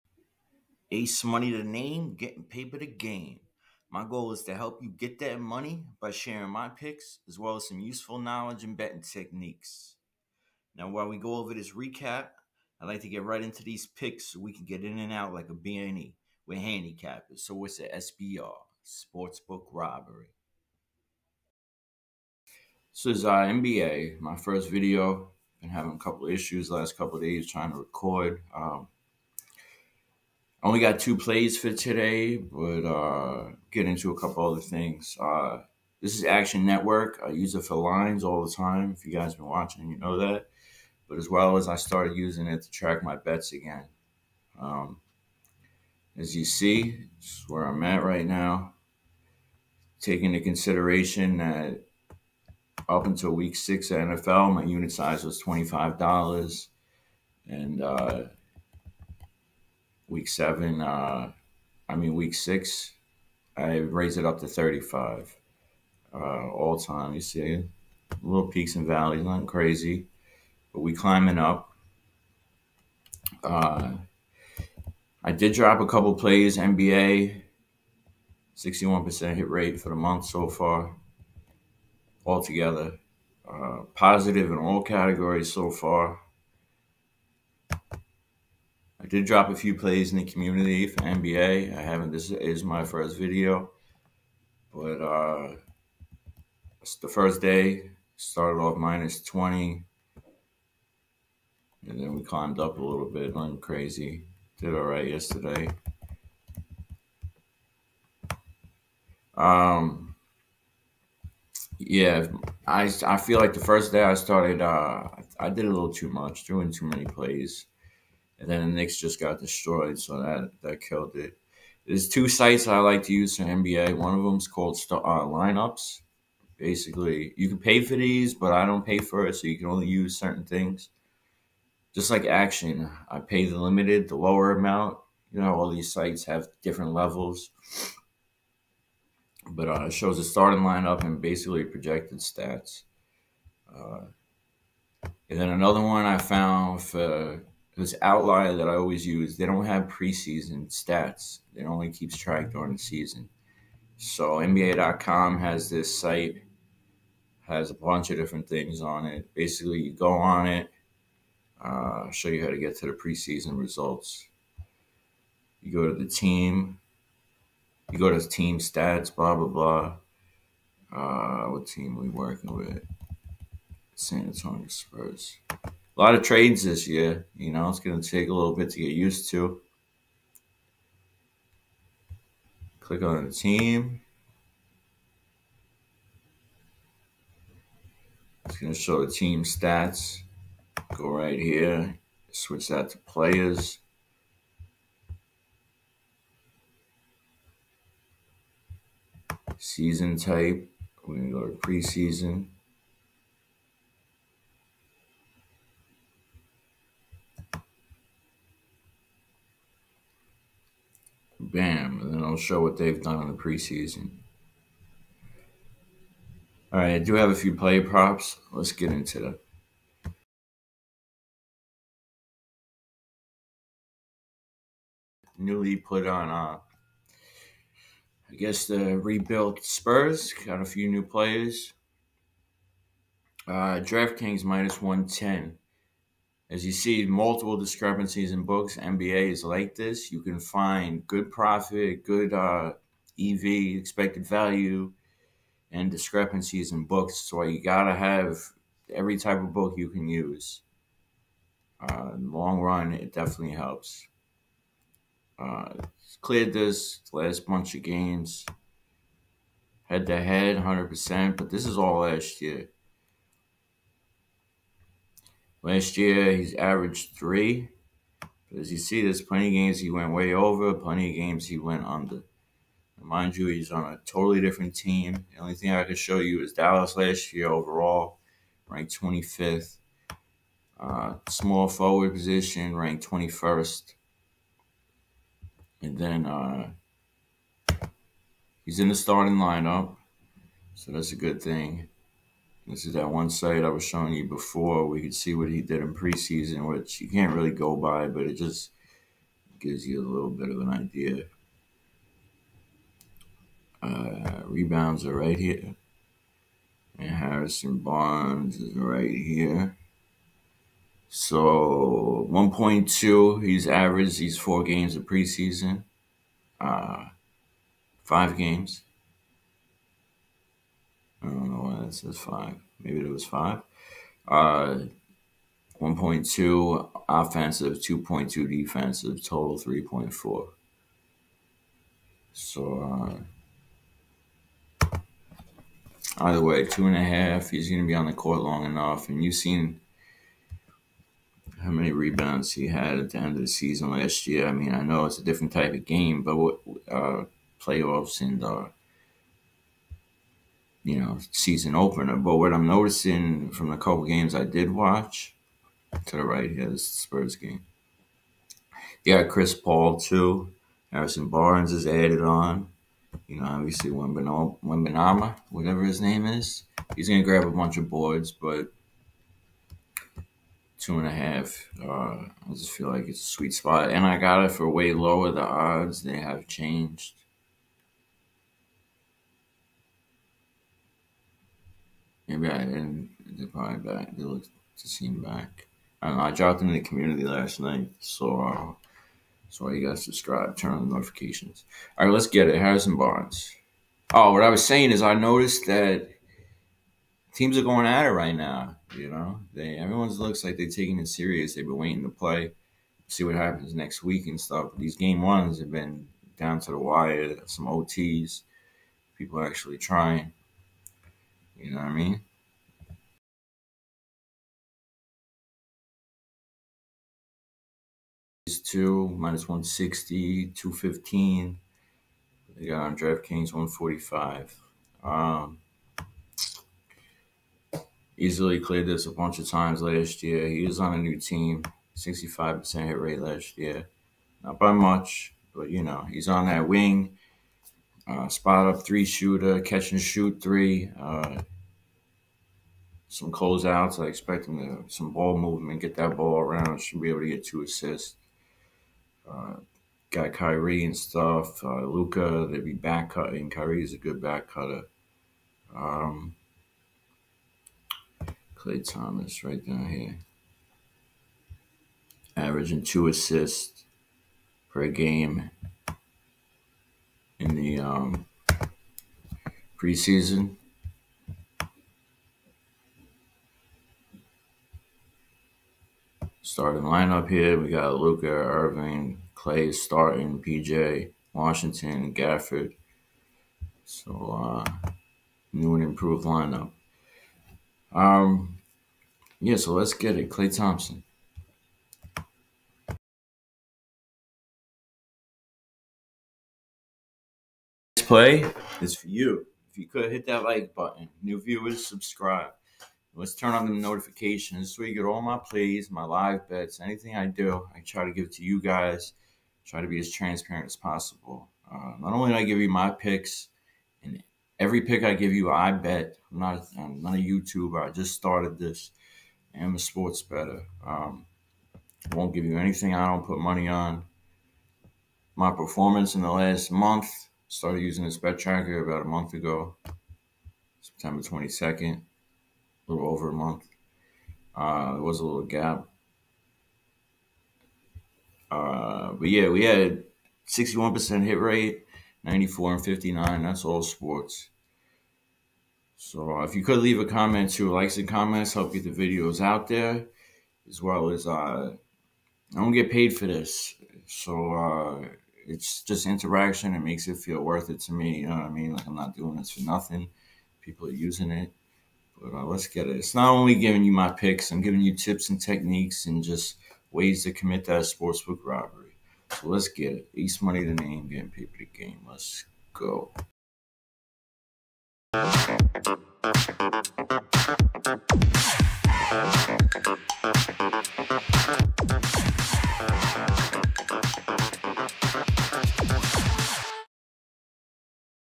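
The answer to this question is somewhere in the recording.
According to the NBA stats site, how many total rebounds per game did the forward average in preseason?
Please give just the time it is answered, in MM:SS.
05:29.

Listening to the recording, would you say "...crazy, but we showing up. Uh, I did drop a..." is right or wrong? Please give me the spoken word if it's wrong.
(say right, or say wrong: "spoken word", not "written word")
wrong: "climbing", not "showing".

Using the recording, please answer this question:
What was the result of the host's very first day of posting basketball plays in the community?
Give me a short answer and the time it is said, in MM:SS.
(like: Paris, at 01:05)
minus 20, at 01:38.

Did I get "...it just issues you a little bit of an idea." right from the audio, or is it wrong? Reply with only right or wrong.
wrong.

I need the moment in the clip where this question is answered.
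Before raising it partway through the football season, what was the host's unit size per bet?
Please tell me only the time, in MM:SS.
00:55.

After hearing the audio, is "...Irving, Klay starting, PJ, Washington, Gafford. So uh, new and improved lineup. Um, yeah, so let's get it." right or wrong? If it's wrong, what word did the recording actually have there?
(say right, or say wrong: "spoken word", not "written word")
right.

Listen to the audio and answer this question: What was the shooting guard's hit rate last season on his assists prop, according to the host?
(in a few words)
65%.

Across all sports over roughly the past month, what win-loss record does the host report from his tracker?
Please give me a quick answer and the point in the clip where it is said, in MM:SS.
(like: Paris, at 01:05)
94 and 59, at 09:02.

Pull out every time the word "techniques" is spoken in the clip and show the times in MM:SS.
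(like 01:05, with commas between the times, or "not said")
00:09, 09:25.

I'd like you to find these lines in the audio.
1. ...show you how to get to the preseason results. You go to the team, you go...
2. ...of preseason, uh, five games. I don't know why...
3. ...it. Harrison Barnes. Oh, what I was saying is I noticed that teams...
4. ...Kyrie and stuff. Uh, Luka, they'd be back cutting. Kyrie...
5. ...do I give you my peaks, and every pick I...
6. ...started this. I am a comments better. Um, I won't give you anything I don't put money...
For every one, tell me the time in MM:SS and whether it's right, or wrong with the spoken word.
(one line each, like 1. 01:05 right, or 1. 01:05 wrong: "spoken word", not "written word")
1. 02:42 right
2. 05:14 right
3. 06:32 right
4. 07:30 right
5. 08:32 wrong: "picks", not "peaks"
6. 08:38 wrong: "sports", not "comments".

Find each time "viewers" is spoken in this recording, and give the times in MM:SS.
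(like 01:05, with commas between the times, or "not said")
08:21.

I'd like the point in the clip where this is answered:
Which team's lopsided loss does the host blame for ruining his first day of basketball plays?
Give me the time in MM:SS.
01:58.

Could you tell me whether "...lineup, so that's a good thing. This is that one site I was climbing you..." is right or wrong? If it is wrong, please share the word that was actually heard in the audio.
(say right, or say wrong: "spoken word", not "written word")
wrong: "showing", not "climbing".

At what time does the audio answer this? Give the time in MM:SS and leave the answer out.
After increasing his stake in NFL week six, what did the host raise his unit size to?
01:04.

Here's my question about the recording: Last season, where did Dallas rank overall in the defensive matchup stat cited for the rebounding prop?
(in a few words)
25th.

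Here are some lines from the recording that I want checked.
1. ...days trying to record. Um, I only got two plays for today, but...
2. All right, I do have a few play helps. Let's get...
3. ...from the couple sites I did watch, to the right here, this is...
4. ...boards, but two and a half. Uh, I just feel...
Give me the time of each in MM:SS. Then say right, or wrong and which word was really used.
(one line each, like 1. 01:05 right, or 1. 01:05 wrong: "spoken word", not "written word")
1. 00:27 right
2. 03:36 wrong: "props", not "helps"
3. 05:53 wrong: "games", not "sites"
4. 06:07 right.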